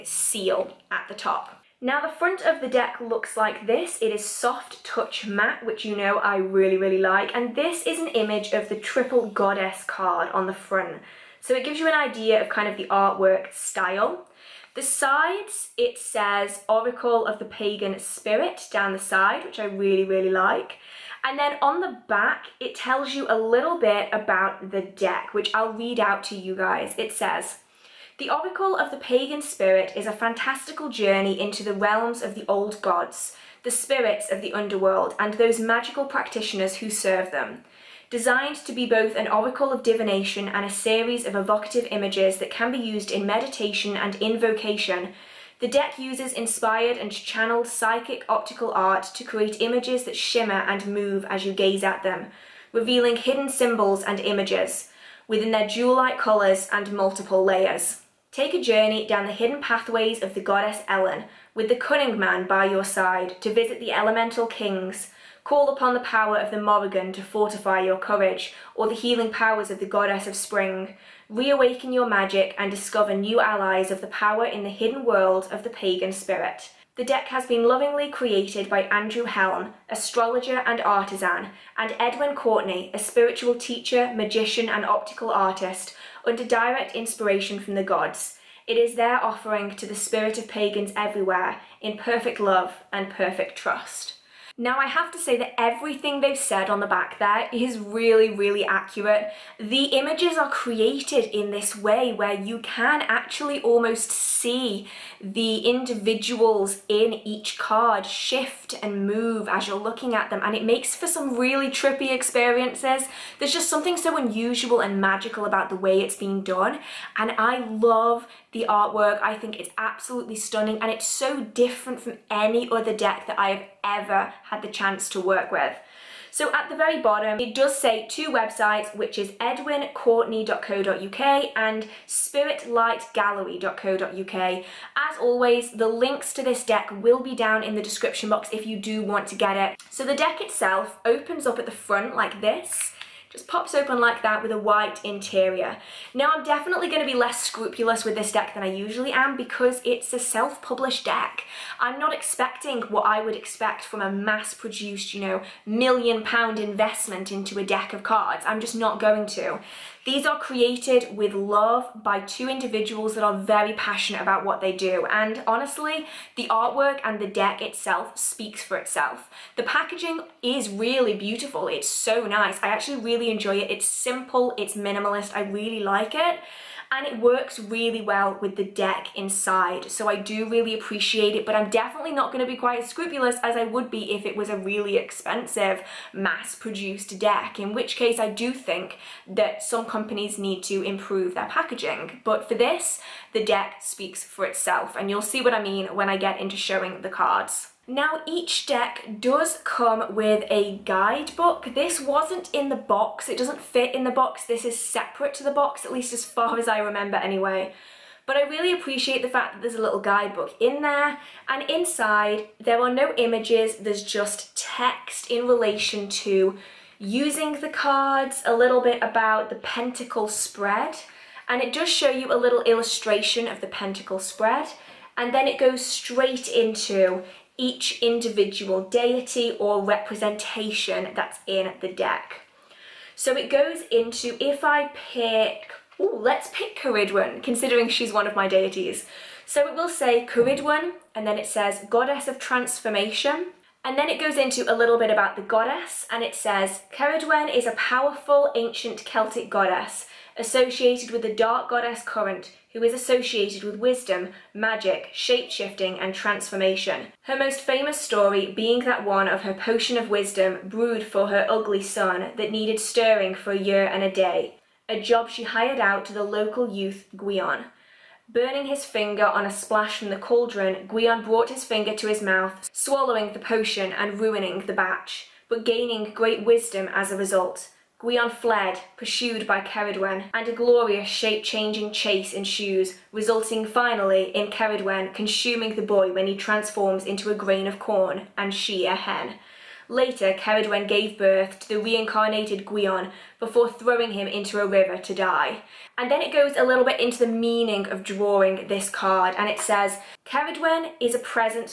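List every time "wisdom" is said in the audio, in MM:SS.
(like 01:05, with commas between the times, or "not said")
04:13, 04:20, 04:36.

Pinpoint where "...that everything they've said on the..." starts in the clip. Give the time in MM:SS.
01:35.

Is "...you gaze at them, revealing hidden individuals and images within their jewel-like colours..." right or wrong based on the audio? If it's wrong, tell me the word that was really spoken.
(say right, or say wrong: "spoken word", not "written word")
wrong: "symbols", not "individuals".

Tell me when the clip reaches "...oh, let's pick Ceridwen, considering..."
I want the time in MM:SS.
03:55.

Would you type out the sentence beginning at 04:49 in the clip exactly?
Later, Ceridwen gave birth to the reincarnated Gwion before throwing him into a river to die.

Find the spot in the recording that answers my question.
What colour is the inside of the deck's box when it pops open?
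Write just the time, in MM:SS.
02:24.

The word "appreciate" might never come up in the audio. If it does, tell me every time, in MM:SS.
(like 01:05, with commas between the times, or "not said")
03:00, 03:28.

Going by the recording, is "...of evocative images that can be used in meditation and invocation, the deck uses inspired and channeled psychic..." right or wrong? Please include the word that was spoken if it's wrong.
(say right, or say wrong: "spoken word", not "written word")
right.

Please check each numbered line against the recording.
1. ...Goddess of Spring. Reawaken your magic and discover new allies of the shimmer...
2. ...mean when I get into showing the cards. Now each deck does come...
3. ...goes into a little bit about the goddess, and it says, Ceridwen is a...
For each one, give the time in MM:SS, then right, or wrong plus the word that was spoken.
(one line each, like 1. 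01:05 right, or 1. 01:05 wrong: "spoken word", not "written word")
1. 01:09 wrong: "power", not "shimmer"
2. 03:15 right
3. 04:04 right.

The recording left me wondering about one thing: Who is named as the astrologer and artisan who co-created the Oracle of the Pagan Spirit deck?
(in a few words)
Andrew Helm.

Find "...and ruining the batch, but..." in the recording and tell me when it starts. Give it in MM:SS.
04:33.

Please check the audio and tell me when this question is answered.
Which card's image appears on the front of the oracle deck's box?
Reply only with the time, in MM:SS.
00:08.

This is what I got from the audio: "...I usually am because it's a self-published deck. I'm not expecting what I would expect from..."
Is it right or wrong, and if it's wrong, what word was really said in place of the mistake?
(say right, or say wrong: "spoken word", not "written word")
right.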